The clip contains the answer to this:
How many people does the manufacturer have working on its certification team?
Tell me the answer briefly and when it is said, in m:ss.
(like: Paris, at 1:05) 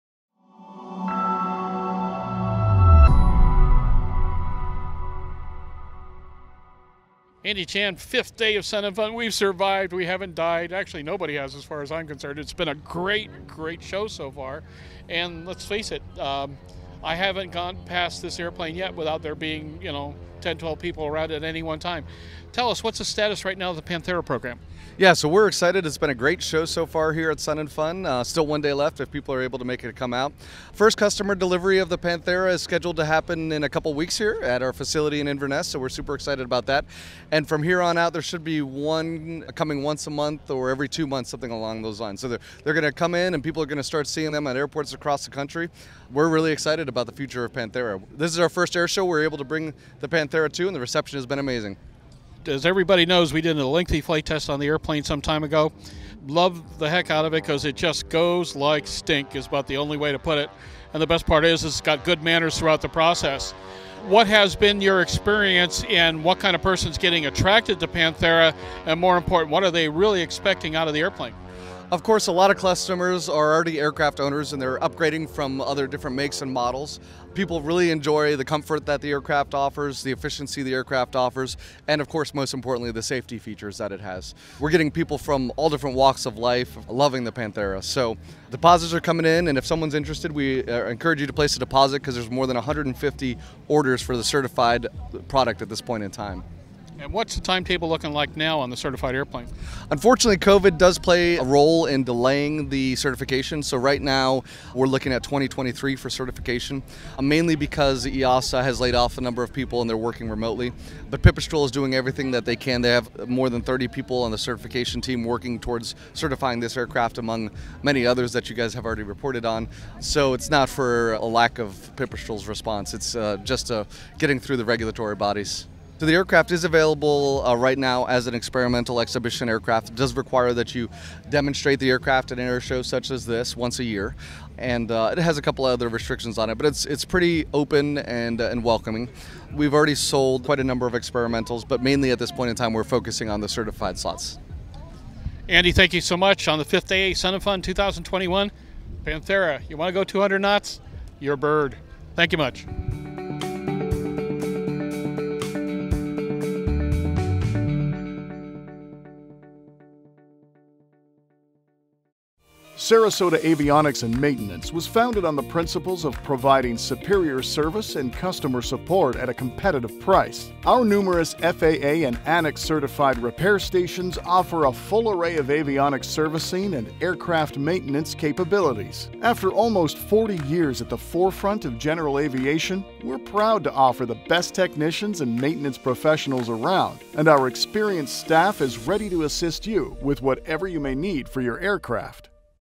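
More than 30, at 1:53.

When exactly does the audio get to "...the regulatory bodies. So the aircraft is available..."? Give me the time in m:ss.
2:04.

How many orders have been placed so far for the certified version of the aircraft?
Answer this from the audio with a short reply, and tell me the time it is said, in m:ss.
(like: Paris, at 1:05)
More than 150, at 1:32.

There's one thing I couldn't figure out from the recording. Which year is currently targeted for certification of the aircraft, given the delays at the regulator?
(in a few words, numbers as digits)
2023.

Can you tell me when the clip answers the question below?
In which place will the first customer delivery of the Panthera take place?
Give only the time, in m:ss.
0:35.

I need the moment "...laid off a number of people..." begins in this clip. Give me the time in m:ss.
1:48.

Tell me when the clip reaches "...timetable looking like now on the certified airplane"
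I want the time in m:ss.
1:37.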